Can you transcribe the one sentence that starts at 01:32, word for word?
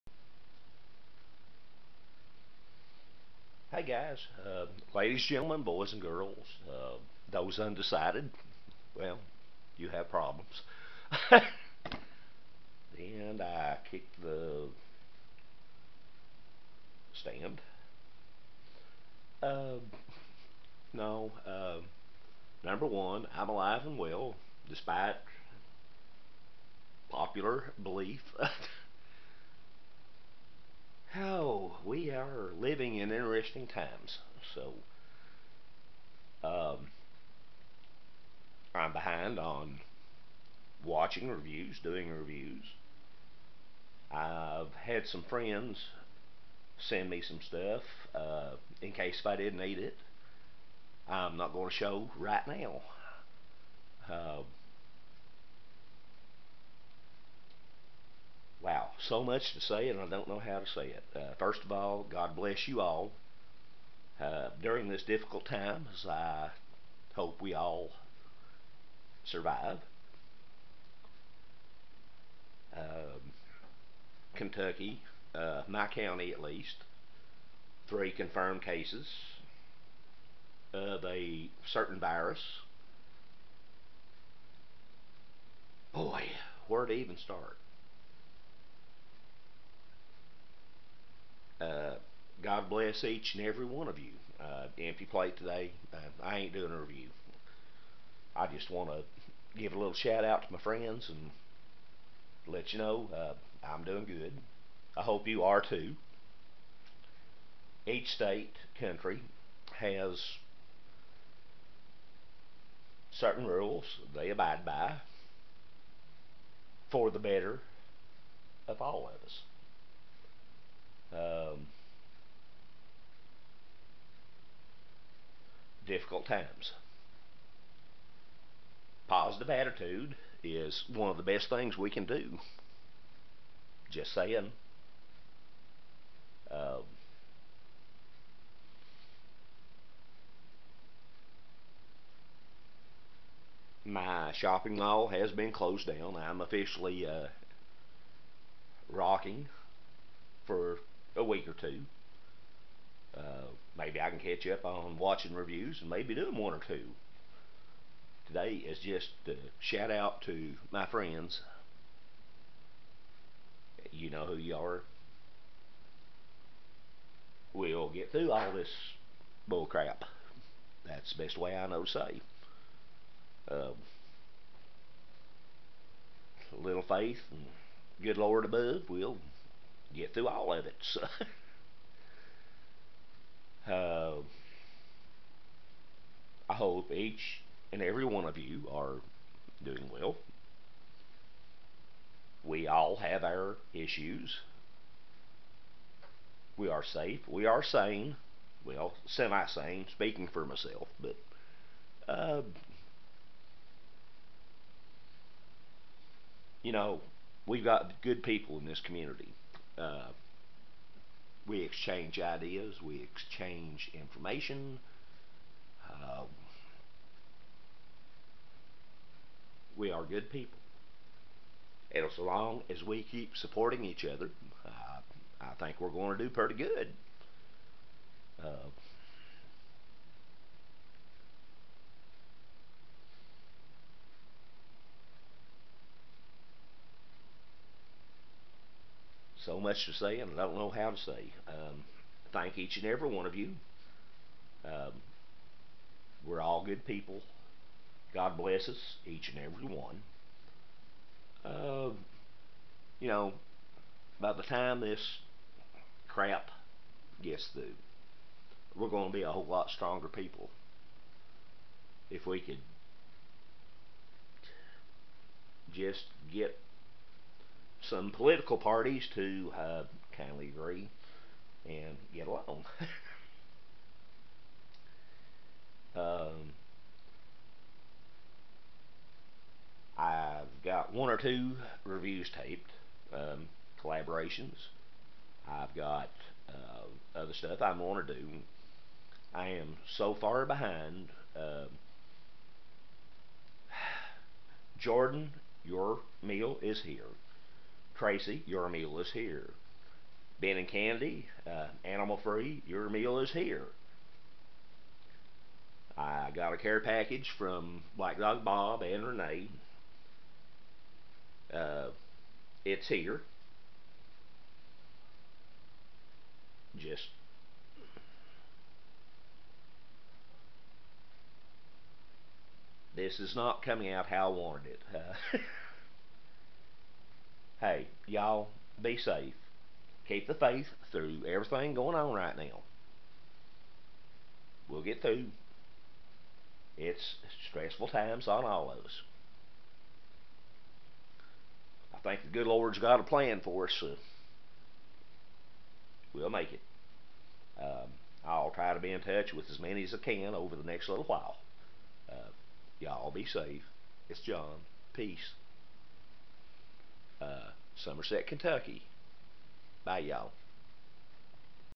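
God bless each and every one of you.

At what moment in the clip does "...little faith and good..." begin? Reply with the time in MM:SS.
02:56.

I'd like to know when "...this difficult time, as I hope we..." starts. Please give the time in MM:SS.
01:04.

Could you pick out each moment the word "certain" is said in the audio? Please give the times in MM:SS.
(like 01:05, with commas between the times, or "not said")
01:21, 01:53.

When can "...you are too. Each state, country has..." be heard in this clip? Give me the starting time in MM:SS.
01:45.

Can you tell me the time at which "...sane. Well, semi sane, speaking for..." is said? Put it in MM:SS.
03:17.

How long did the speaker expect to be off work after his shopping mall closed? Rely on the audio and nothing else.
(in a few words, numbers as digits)
a week or two.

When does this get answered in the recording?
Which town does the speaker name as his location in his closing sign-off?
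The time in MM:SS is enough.
05:57.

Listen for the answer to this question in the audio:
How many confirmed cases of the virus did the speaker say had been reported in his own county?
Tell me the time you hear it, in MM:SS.
01:17.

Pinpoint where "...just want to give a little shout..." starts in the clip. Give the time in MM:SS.
01:38.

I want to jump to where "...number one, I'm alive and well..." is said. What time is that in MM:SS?
00:22.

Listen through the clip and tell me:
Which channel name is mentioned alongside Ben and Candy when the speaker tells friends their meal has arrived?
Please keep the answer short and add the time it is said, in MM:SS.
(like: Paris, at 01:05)
Animal Free, at 05:01.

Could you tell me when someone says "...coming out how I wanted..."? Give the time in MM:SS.
05:23.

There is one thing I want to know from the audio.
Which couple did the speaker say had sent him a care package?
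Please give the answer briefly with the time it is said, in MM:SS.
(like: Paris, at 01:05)
Black Dog Bob and Renee, at 05:07.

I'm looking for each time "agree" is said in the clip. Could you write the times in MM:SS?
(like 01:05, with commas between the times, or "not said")
04:30.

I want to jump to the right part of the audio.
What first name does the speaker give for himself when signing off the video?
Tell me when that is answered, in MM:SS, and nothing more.
05:54.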